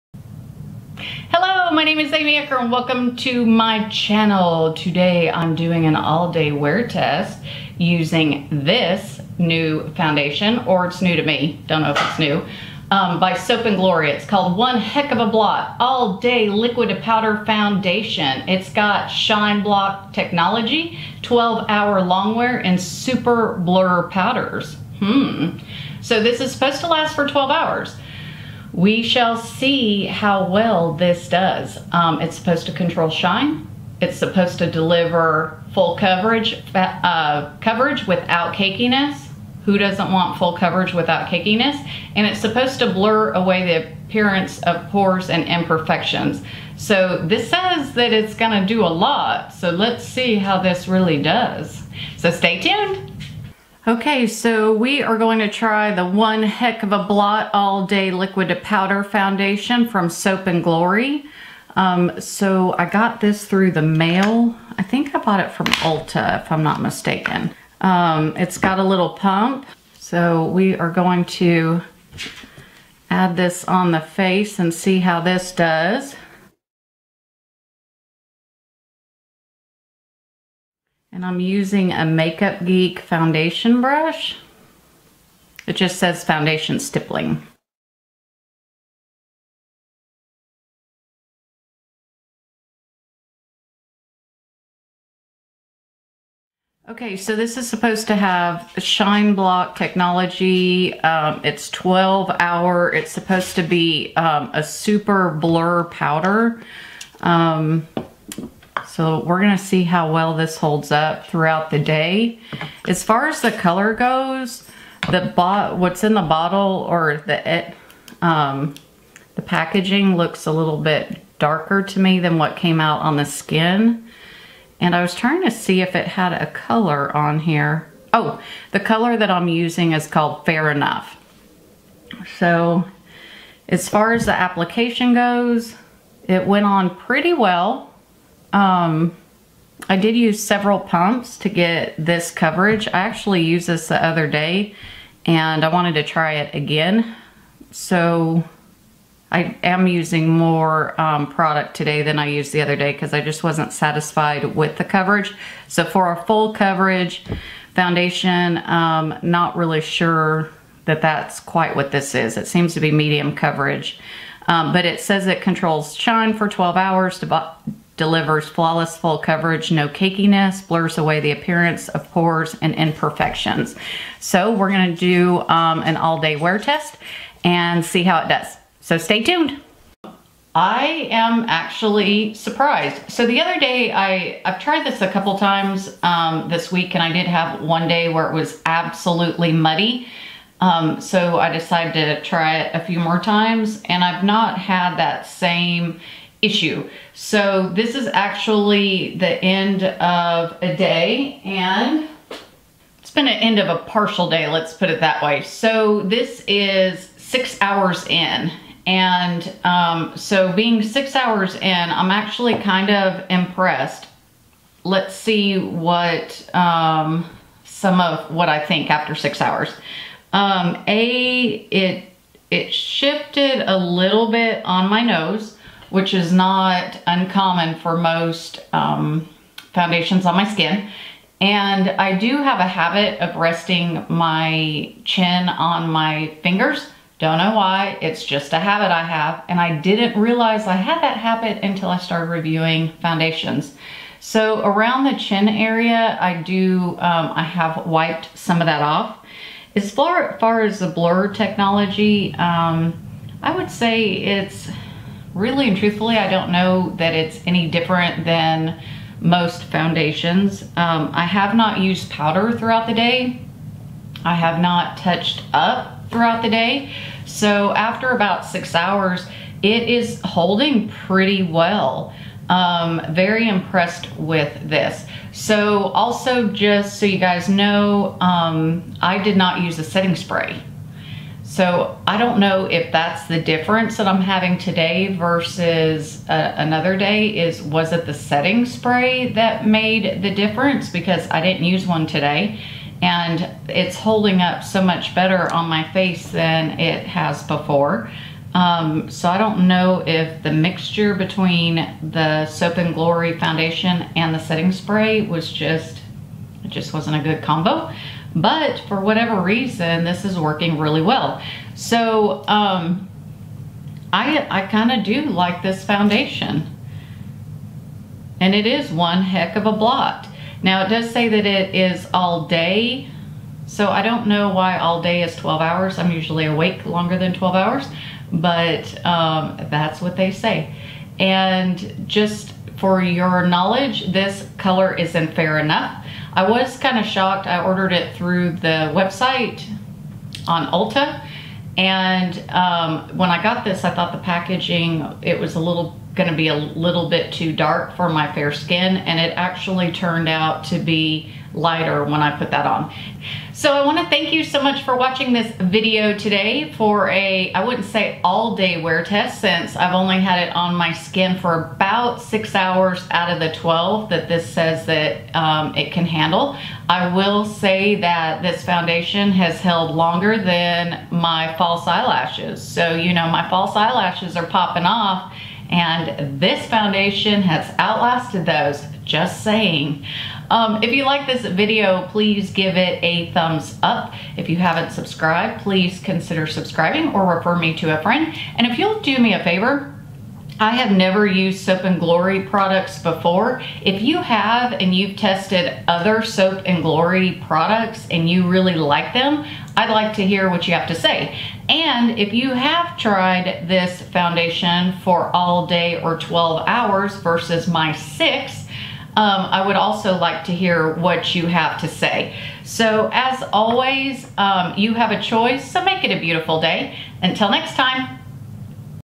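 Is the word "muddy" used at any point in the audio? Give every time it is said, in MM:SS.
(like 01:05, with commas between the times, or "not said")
03:09.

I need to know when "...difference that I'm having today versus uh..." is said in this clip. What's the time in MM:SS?
04:43.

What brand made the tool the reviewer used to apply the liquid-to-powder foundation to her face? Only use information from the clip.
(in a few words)
Makeup Geek.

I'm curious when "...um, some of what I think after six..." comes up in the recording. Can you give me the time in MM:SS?
03:36.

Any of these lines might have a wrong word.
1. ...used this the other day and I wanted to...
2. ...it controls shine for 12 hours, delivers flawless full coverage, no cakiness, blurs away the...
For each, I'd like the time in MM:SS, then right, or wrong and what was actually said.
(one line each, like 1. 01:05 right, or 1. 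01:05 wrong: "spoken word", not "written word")
1. 02:23 right
2. 02:45 right.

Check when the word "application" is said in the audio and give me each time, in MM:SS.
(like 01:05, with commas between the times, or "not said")
02:14.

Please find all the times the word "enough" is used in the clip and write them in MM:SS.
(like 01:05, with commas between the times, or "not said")
02:10, 05:35.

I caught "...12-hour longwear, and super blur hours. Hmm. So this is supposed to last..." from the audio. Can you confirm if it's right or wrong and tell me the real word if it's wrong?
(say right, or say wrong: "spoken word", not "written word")
wrong: "powders", not "hours".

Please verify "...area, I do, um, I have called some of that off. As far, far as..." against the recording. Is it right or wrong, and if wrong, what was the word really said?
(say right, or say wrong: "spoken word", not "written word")
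wrong: "wiped", not "called".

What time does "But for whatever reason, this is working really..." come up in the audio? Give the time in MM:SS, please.
05:08.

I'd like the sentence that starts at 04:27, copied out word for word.
So after about six hours, it is holding pretty well.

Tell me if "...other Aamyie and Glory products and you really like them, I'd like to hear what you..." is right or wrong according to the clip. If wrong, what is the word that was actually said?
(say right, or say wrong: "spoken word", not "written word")
wrong: "Soap", not "Aamyie".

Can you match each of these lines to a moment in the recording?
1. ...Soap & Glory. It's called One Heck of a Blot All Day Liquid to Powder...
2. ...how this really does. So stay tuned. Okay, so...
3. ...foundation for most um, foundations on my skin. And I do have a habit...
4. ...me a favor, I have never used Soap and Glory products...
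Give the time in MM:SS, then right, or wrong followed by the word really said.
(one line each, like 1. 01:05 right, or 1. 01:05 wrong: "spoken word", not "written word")
1. 00:13 right
2. 00:50 right
3. 03:47 wrong: "uncommon", not "foundation"
4. 06:29 right.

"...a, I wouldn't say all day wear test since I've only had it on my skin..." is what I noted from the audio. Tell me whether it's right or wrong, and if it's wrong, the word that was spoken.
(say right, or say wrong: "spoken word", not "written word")
right.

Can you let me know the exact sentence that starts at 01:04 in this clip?
I think I bought it from Ulta, if I'm not mistaken.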